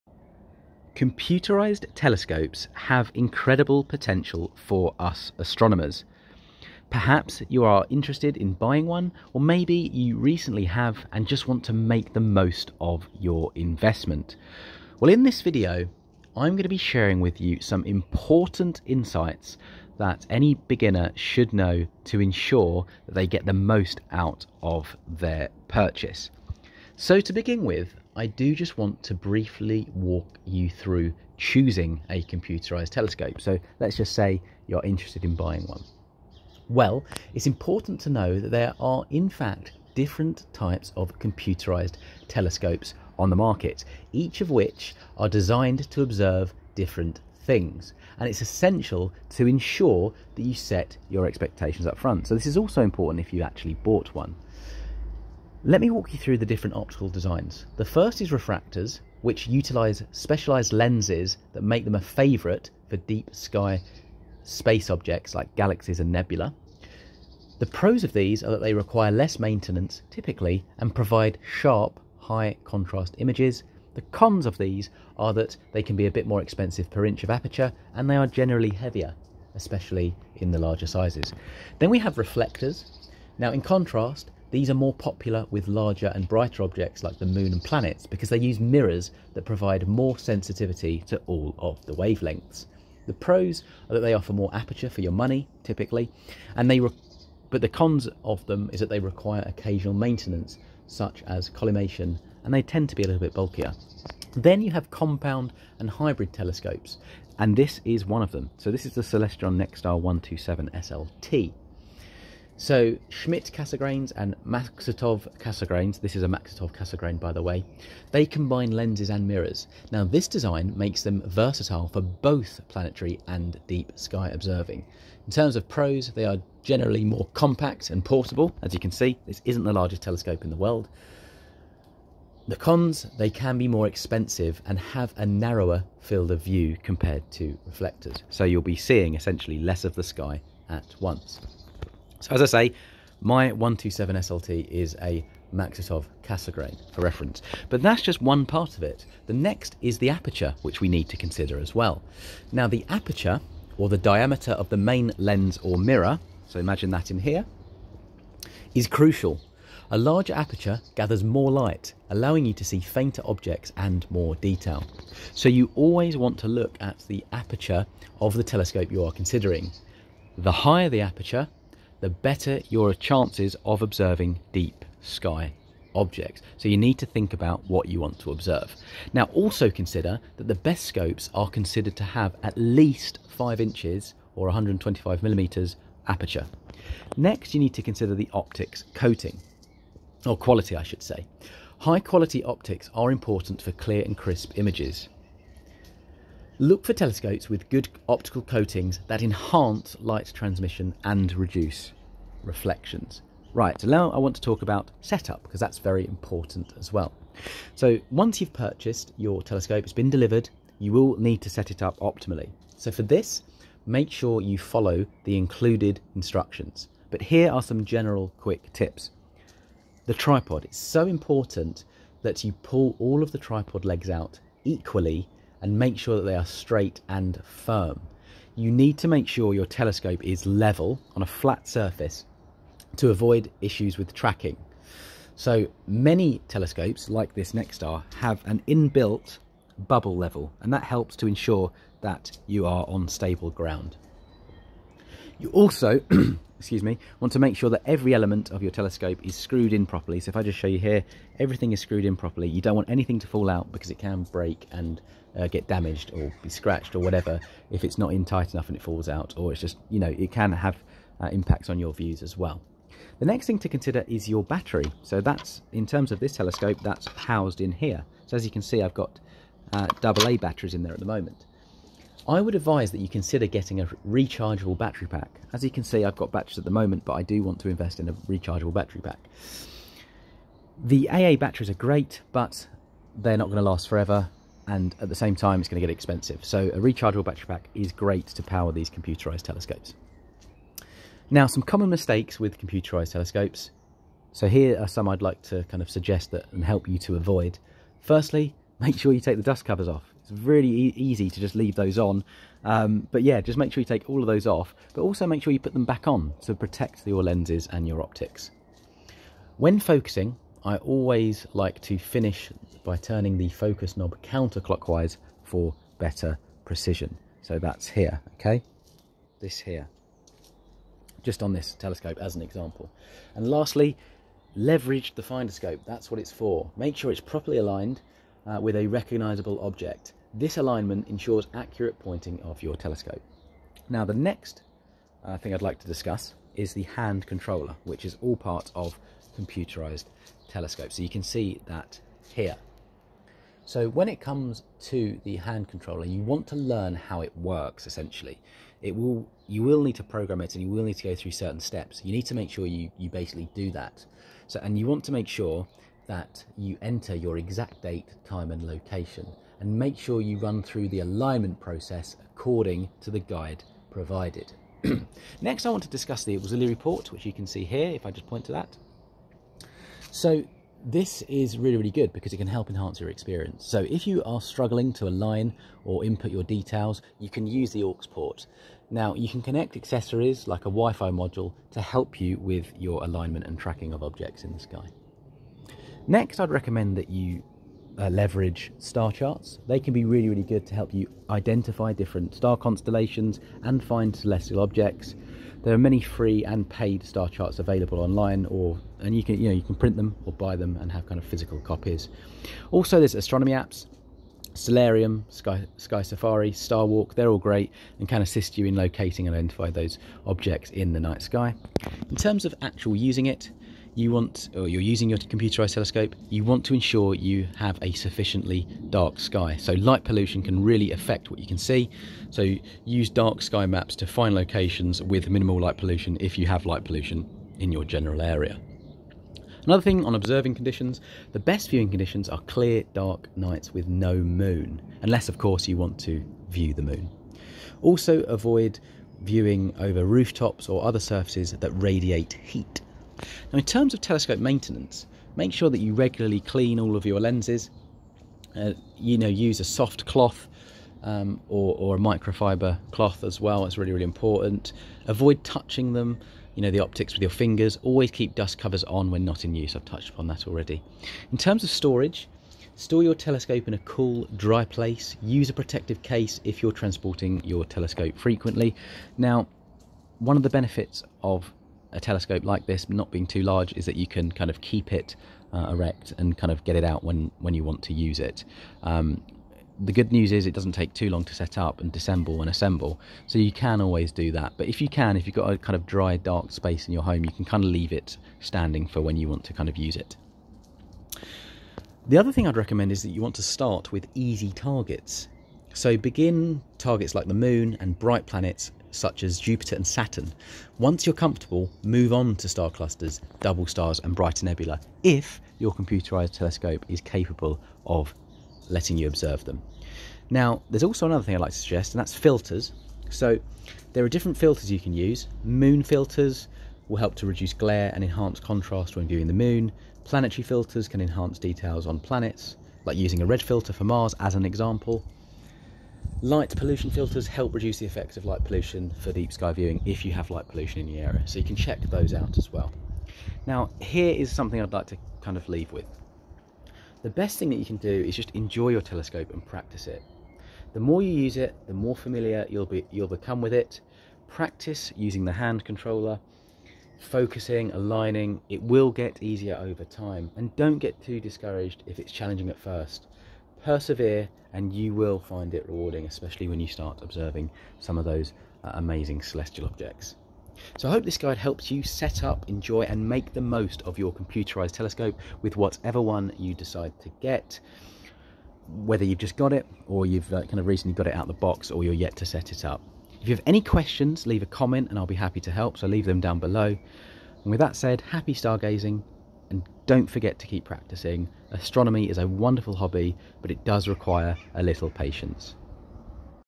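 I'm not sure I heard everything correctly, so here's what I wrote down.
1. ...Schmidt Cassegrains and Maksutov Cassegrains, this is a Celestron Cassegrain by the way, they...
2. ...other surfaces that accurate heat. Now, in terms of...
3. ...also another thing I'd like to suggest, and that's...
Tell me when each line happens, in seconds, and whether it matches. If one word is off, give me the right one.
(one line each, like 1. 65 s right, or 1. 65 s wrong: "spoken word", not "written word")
1. 113 s wrong: "Maksutov", not "Celestron"
2. 440 s wrong: "radiate", not "accurate"
3. 510 s right.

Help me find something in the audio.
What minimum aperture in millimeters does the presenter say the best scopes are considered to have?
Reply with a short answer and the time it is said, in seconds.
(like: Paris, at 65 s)
125 millimeters, at 184 s.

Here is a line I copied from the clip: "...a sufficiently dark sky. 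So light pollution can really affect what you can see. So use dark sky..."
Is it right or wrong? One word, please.
right.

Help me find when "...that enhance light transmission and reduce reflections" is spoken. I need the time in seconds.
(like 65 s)
199 s.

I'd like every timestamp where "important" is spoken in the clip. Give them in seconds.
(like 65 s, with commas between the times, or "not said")
17 s, 37 s, 52 s, 193 s, 206 s, 221 s, 454 s.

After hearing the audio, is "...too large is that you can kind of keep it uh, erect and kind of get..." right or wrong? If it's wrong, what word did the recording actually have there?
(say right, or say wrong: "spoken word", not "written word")
right.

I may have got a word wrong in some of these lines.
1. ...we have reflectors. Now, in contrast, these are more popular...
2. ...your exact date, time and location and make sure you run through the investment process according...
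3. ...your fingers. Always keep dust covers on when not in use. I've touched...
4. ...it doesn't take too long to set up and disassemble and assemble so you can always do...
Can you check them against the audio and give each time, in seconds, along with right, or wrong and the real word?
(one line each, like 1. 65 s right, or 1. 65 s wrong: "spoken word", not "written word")
1. 81 s right
2. 357 s wrong: "alignment", not "investment"
3. 457 s right
4. 480 s right.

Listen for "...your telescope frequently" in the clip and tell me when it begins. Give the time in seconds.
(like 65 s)
467 s.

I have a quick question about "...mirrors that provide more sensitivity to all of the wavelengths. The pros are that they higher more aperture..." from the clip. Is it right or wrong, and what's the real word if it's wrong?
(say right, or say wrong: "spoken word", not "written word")
wrong: "offer", not "higher".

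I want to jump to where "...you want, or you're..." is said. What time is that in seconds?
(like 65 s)
413 s.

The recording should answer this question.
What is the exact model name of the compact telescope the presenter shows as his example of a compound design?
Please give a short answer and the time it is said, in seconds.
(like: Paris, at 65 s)
Celestron Nexstar 127 SLT, at 109 s.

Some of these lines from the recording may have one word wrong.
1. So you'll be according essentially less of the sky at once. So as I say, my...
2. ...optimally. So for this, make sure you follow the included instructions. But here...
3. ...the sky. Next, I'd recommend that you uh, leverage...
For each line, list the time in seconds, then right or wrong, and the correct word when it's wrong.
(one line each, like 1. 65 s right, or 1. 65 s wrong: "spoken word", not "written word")
1. 138 s wrong: "seeing", not "according"
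2. 211 s right
3. 384 s right.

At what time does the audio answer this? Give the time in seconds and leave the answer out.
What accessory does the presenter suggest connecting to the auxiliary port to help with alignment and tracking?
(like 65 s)
380 s.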